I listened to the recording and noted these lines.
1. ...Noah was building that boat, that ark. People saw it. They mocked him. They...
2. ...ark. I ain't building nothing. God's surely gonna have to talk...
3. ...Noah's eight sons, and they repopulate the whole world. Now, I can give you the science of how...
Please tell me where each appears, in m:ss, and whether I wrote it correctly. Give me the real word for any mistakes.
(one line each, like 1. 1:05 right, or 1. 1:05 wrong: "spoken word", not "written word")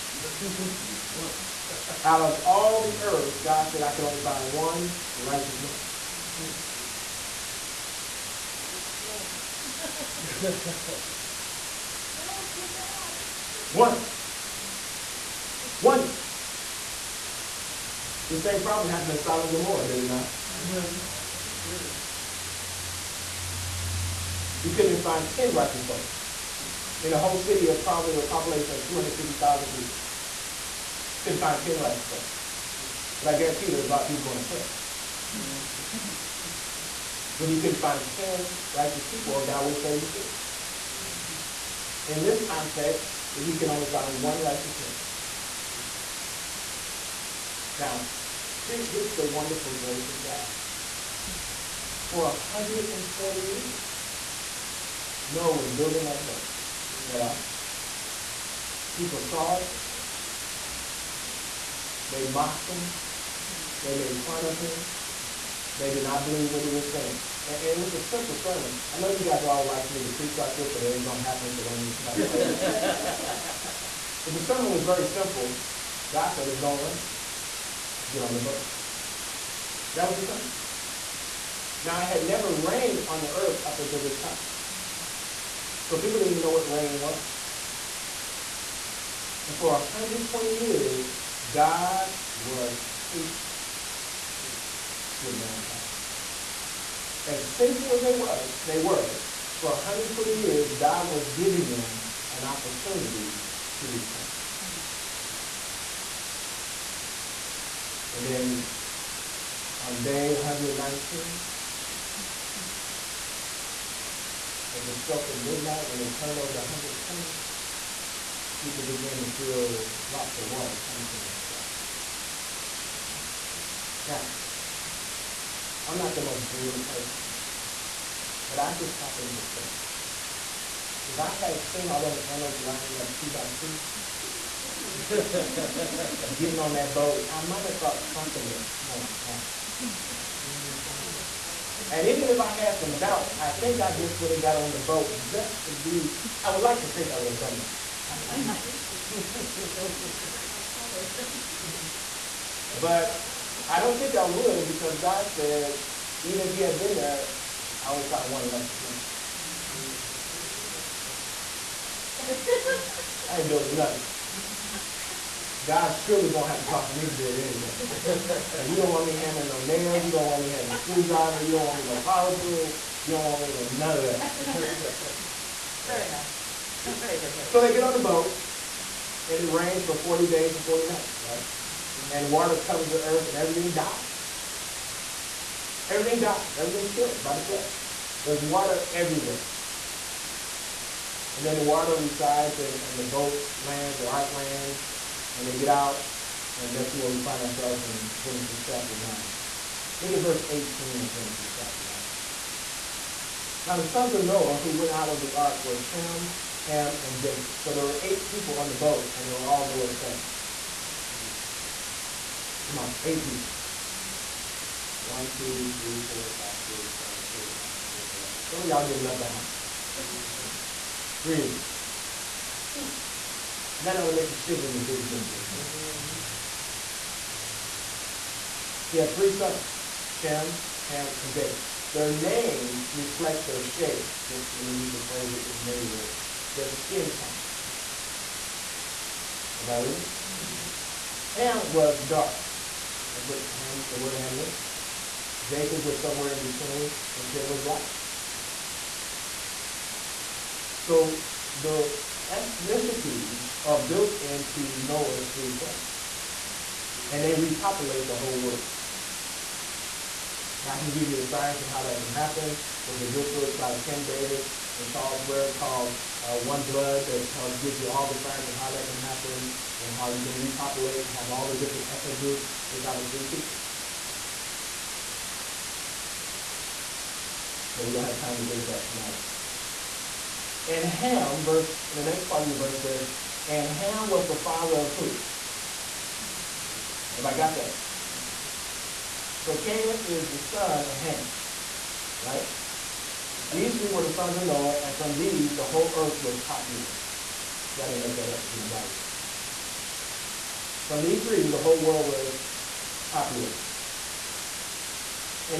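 1. 0:55 right
2. 2:41 right
3. 4:14 wrong: "three", not "eight".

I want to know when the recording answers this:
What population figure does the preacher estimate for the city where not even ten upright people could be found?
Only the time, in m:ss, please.
0:28.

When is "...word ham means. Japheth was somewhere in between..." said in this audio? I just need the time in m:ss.
4:03.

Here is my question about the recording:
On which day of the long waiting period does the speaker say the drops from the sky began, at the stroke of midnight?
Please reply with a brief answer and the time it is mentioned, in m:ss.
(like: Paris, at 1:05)
119, at 1:50.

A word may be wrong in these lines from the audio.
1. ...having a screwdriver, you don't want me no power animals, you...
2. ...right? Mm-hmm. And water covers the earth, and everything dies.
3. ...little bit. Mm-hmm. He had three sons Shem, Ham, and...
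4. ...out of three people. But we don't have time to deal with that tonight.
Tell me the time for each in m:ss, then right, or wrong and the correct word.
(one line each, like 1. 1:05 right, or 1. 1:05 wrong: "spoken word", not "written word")
1. 2:50 wrong: "tools", not "animals"
2. 3:01 right
3. 3:45 right
4. 4:32 right.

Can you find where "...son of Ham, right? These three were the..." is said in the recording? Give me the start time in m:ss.
4:50.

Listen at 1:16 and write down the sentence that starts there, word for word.
God said it's going to rain.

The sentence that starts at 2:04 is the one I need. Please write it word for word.
Now, I'm not the most brilliant person, but I just happened to think.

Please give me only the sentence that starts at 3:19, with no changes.
Look at verse 18 of Genesis chapter 9.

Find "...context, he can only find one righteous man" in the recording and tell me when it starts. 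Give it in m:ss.
0:42.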